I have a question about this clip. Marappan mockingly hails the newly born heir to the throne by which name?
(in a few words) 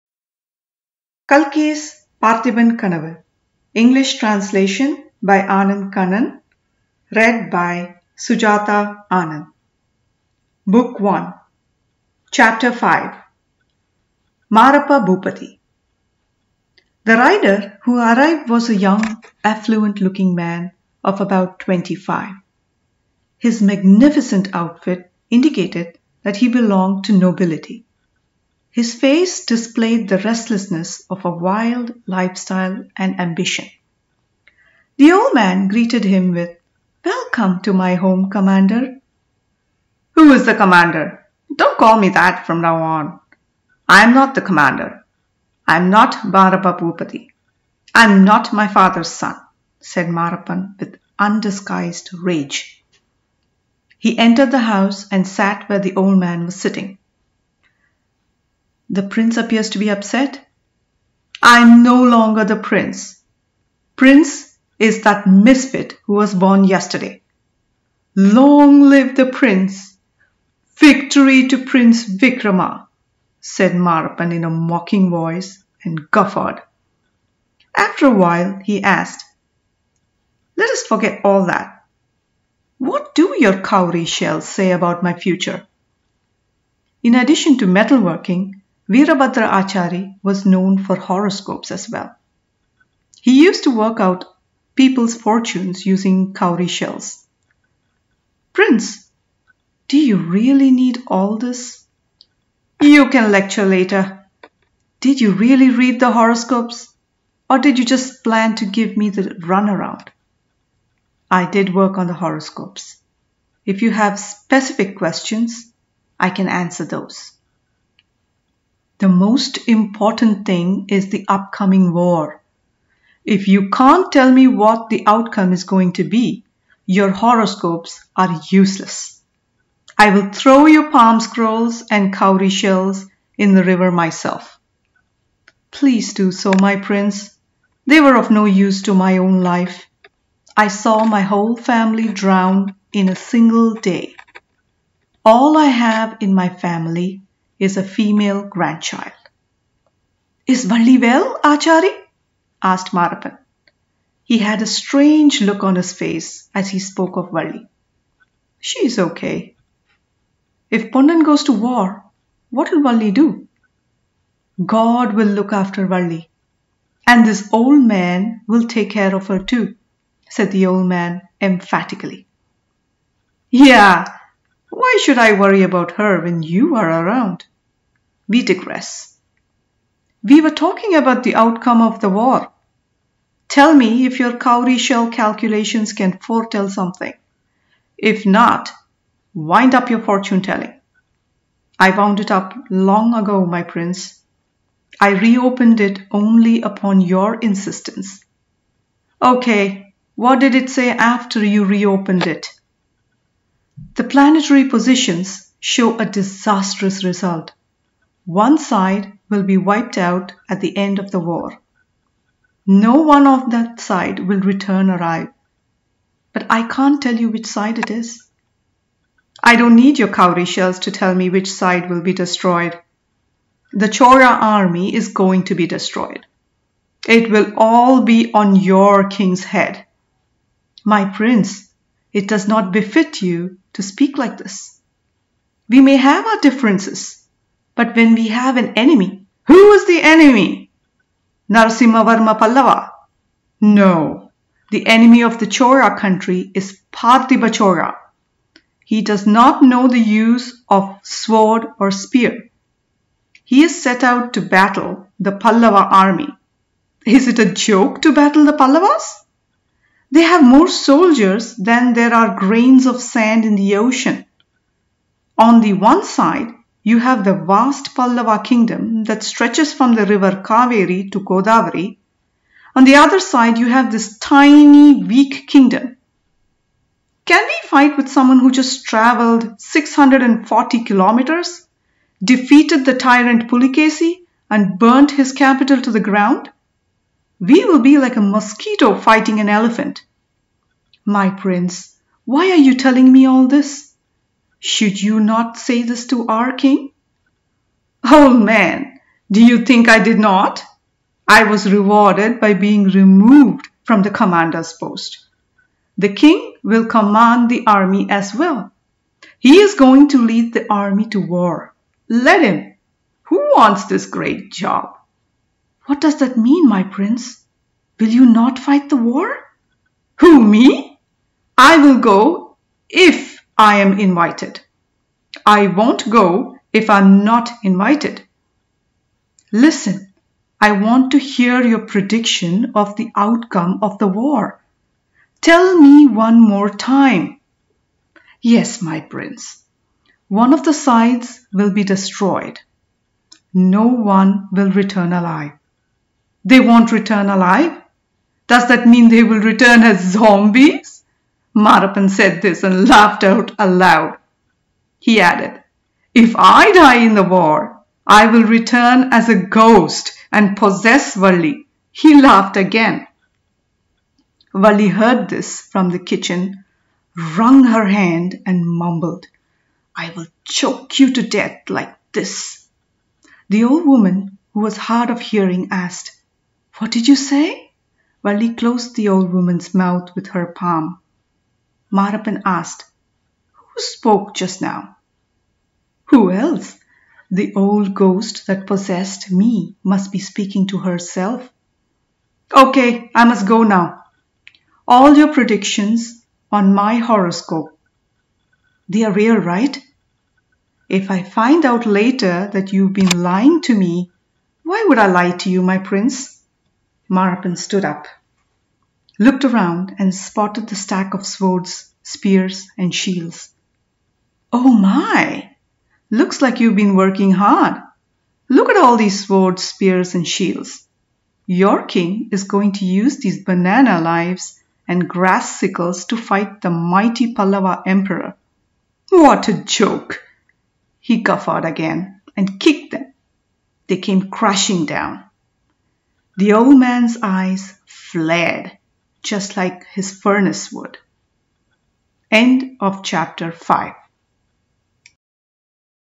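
Prince Vikrama.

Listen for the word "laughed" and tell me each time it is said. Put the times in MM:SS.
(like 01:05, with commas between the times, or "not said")
05:52, 06:02.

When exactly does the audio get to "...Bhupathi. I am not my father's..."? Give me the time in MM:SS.
00:46.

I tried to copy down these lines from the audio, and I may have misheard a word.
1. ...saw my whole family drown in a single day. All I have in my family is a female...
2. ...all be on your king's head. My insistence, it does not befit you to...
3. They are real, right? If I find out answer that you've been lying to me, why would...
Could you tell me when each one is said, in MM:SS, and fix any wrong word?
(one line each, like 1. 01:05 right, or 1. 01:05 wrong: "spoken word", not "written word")
1. 02:20 right
2. 03:47 wrong: "prince", not "insistence"
3. 06:38 wrong: "later", not "answer".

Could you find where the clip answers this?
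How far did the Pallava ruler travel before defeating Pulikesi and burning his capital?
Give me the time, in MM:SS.
04:39.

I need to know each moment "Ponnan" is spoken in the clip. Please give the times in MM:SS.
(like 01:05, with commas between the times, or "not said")
02:40.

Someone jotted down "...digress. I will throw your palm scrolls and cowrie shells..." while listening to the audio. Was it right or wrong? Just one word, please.
wrong.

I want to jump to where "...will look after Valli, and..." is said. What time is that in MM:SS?
02:45.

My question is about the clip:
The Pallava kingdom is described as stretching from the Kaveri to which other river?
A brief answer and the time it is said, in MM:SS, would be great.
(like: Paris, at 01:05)
Godavari, at 04:31.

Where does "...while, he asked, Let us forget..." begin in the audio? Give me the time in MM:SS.
01:18.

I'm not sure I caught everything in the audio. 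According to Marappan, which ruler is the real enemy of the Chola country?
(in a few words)
Parthiba Chola.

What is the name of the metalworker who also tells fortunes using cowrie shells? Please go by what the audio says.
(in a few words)
Virabhadra Achari.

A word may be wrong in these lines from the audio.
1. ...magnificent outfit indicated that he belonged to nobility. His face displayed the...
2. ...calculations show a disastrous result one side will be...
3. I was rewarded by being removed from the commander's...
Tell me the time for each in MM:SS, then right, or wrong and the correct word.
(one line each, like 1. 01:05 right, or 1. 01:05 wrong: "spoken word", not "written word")
1. 00:23 right
2. 03:24 wrong: "positions", not "calculations"
3. 05:01 right.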